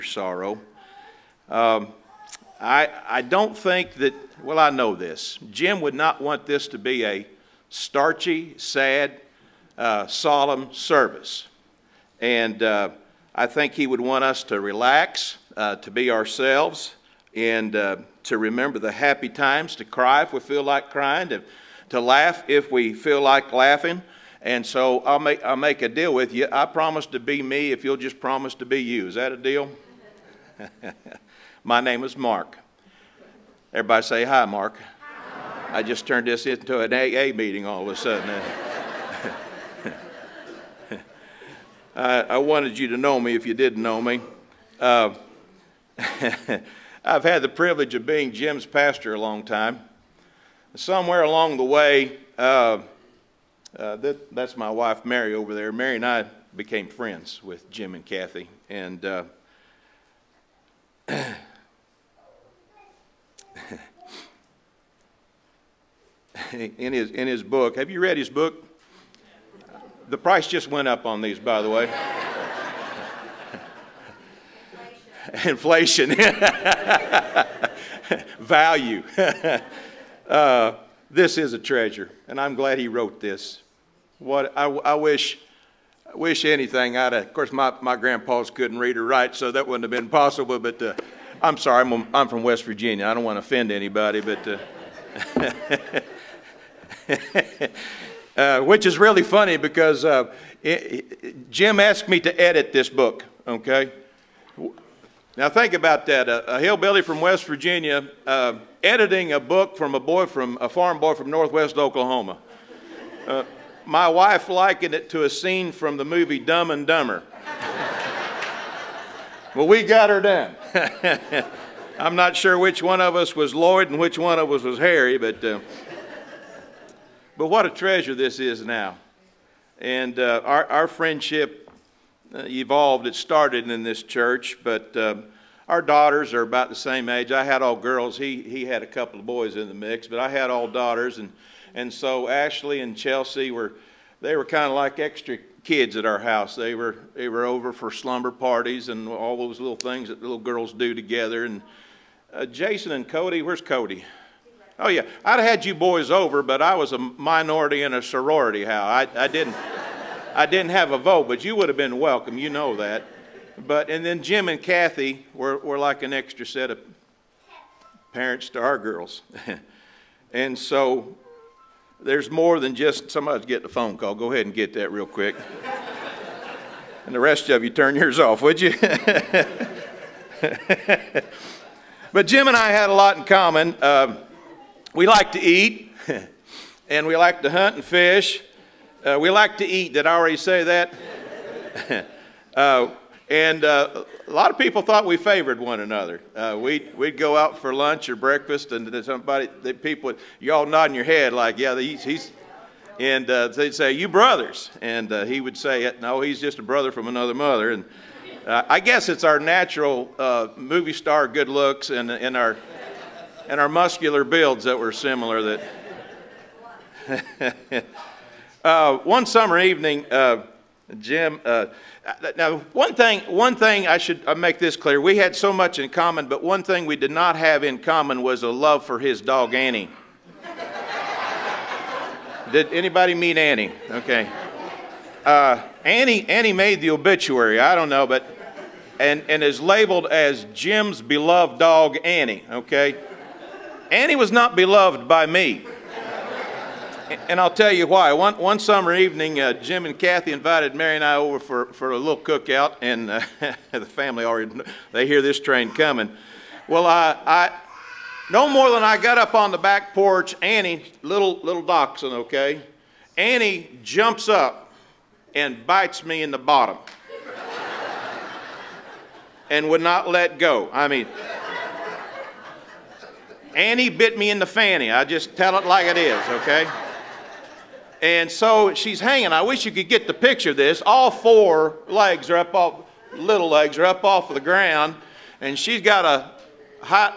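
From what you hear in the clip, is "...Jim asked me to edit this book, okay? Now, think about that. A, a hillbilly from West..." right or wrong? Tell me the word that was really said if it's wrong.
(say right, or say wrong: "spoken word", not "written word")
right.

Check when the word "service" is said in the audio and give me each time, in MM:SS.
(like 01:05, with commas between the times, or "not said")
00:10.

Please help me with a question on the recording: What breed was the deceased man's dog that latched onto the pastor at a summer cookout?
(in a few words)
Dachshund.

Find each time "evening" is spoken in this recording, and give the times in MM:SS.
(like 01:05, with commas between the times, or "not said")
03:39, 04:08.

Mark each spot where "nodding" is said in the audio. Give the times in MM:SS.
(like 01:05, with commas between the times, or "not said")
03:20.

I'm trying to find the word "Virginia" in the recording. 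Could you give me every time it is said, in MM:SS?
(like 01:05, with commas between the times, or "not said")
01:32, 01:47.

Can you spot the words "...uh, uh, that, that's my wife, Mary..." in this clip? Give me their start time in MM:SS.
00:52.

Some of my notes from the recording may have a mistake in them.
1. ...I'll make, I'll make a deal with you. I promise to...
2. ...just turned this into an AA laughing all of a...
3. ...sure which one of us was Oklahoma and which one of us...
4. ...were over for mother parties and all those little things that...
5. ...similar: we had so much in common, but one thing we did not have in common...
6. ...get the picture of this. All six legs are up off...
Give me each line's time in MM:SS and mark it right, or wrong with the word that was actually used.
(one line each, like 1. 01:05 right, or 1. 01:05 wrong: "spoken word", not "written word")
1. 00:24 right
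2. 00:35 wrong: "meeting", not "laughing"
3. 02:02 wrong: "Lloyd", not "Oklahoma"
4. 02:27 wrong: "slumber", not "mother"
5. 03:44 wrong: "clear", not "similar"
6. 04:39 wrong: "four", not "six".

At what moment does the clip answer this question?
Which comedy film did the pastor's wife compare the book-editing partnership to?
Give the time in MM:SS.
01:56.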